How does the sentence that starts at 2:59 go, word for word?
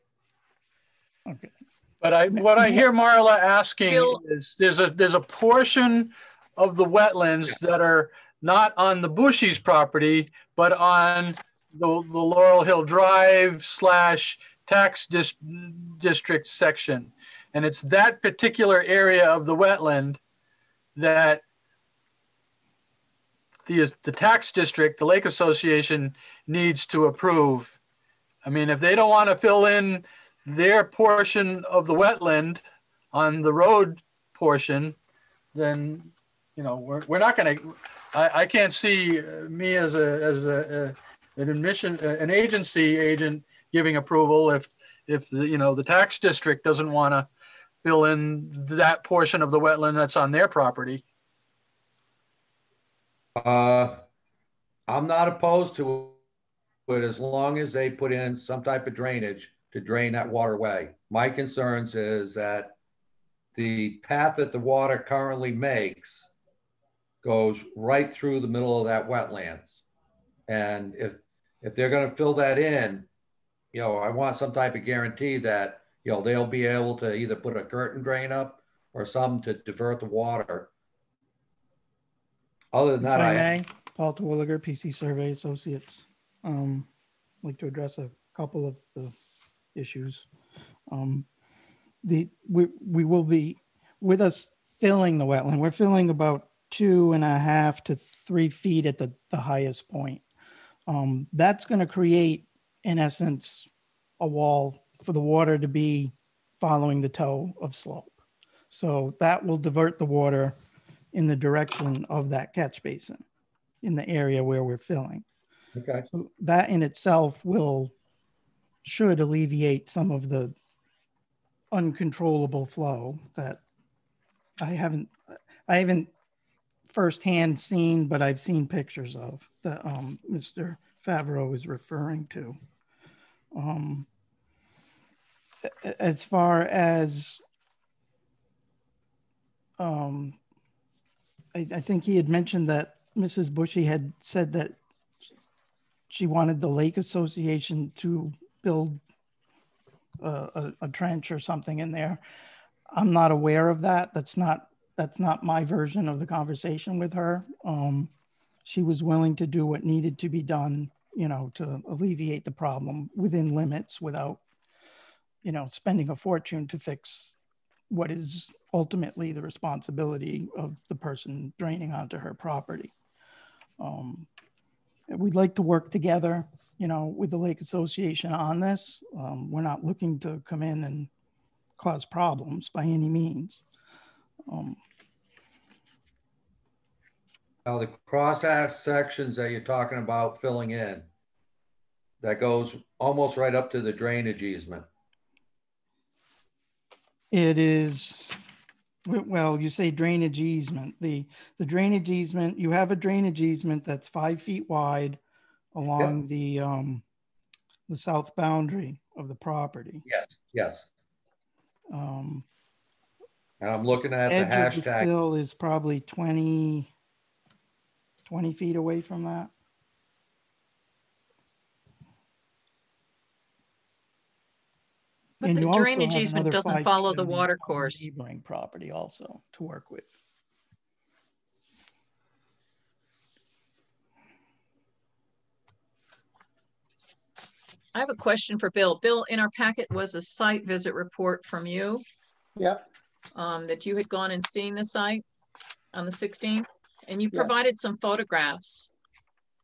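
Um, we're not looking to come in and cause problems by any means.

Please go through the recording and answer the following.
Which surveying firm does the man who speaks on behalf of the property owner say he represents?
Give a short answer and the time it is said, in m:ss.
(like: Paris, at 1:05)
PC Survey Associates, at 1:24.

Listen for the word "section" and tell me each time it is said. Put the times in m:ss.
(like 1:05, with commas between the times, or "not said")
0:16, 3:08.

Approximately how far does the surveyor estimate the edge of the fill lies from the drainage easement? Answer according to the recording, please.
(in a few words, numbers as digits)
20 feet.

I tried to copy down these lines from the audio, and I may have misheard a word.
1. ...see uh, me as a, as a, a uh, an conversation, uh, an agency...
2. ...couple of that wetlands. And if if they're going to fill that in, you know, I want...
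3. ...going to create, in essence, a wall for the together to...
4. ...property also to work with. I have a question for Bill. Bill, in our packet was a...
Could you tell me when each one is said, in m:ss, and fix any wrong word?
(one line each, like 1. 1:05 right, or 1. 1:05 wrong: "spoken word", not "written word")
1. 0:38 wrong: "admission", not "conversation"
2. 1:08 wrong: "middle", not "couple"
3. 1:41 wrong: "water", not "together"
4. 3:48 right.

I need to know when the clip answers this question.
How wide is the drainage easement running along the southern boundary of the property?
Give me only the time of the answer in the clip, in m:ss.
3:24.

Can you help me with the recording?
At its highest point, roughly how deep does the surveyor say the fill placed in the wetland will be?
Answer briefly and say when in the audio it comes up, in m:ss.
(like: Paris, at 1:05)
2.5 to 3 feet, at 1:36.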